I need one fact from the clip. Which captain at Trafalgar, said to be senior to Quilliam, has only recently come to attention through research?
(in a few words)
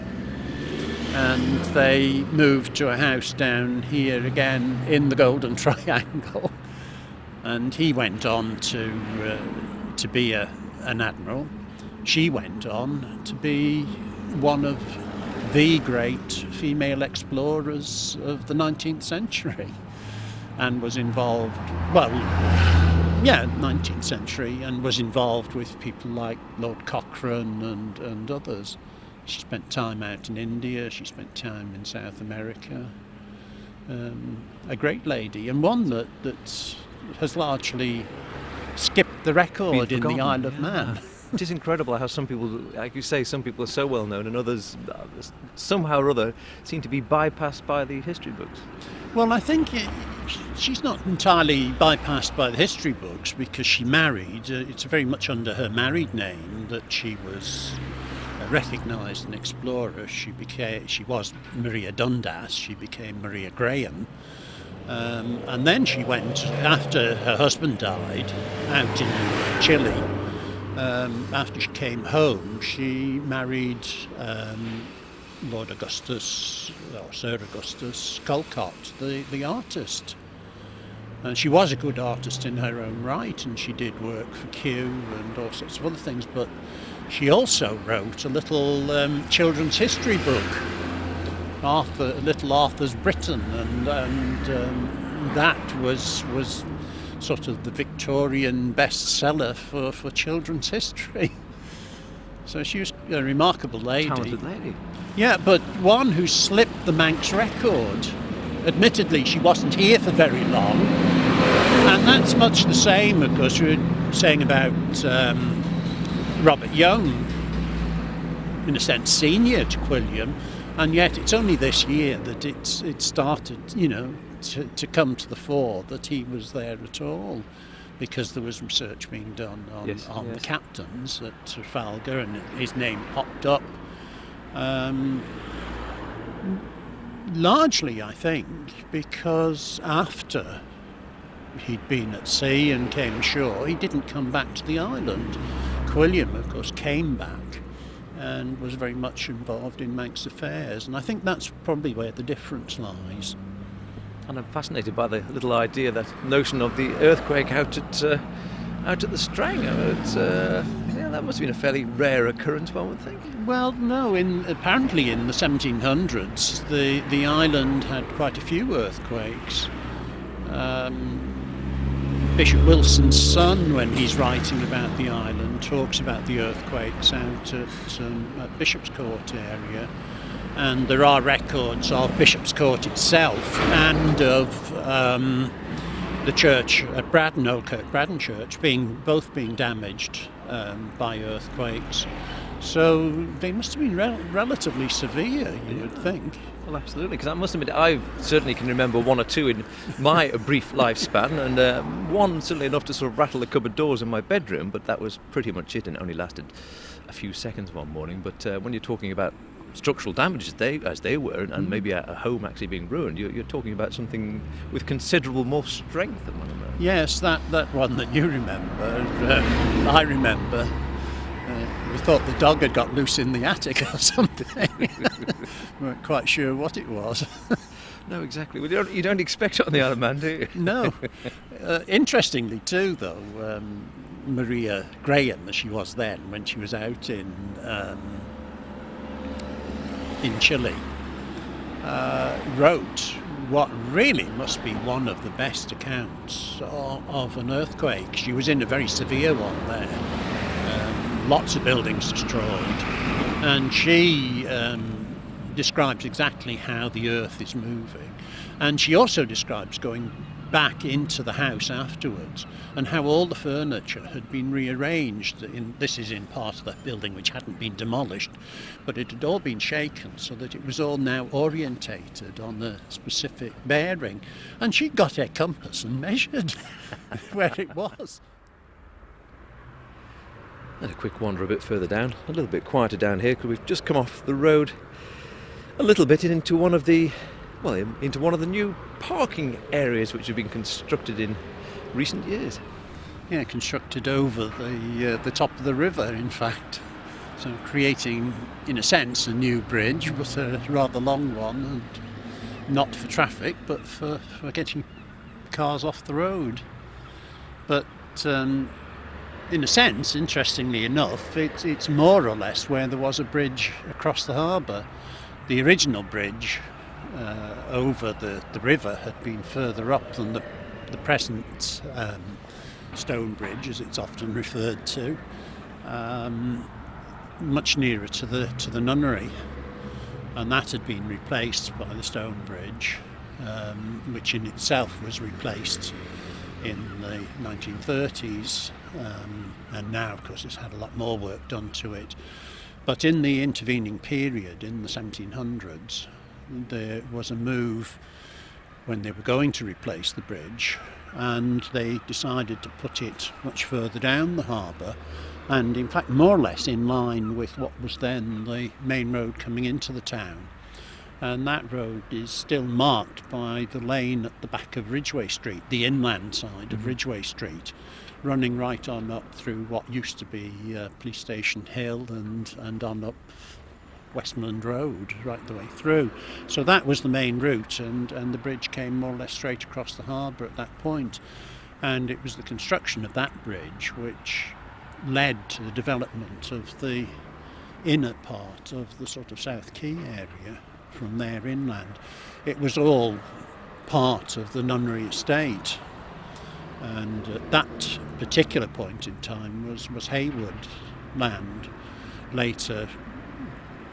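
Robert Young.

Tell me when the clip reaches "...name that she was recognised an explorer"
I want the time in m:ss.
0:56.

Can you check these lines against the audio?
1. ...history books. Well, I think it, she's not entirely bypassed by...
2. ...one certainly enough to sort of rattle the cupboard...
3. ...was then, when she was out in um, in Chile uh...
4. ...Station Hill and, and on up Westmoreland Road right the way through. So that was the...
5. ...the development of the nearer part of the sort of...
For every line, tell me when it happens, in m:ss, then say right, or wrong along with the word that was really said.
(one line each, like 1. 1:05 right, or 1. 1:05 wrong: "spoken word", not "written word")
1. 0:48 right
2. 3:22 right
3. 3:55 right
4. 6:11 right
5. 6:25 wrong: "inner", not "nearer".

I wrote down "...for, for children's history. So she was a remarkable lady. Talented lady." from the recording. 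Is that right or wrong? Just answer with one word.
right.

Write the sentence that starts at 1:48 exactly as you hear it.
Admittedly, she wasn't here for very long.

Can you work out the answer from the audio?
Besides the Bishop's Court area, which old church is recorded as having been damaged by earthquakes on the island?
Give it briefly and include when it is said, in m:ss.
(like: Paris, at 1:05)
Old Kirk Braddan, at 3:07.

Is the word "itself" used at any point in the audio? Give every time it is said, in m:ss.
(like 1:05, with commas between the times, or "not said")
3:02, 5:34.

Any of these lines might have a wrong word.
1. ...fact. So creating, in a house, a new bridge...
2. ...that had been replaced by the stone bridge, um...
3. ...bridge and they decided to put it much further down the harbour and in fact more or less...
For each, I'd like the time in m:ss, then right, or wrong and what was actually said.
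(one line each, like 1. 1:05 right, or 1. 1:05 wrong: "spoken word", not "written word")
1. 4:56 wrong: "sense", not "house"
2. 5:30 right
3. 5:50 right.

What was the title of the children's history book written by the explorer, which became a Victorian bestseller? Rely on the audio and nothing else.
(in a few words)
Little Arthur's Britain.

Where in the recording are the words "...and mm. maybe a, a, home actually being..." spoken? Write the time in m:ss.
3:31.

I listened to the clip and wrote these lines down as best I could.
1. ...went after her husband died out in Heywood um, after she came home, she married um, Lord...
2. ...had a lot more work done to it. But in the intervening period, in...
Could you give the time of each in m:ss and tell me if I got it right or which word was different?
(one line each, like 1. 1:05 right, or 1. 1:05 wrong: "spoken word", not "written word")
1. 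1:06 wrong: "Chile", not "Heywood"
2. 5:40 right.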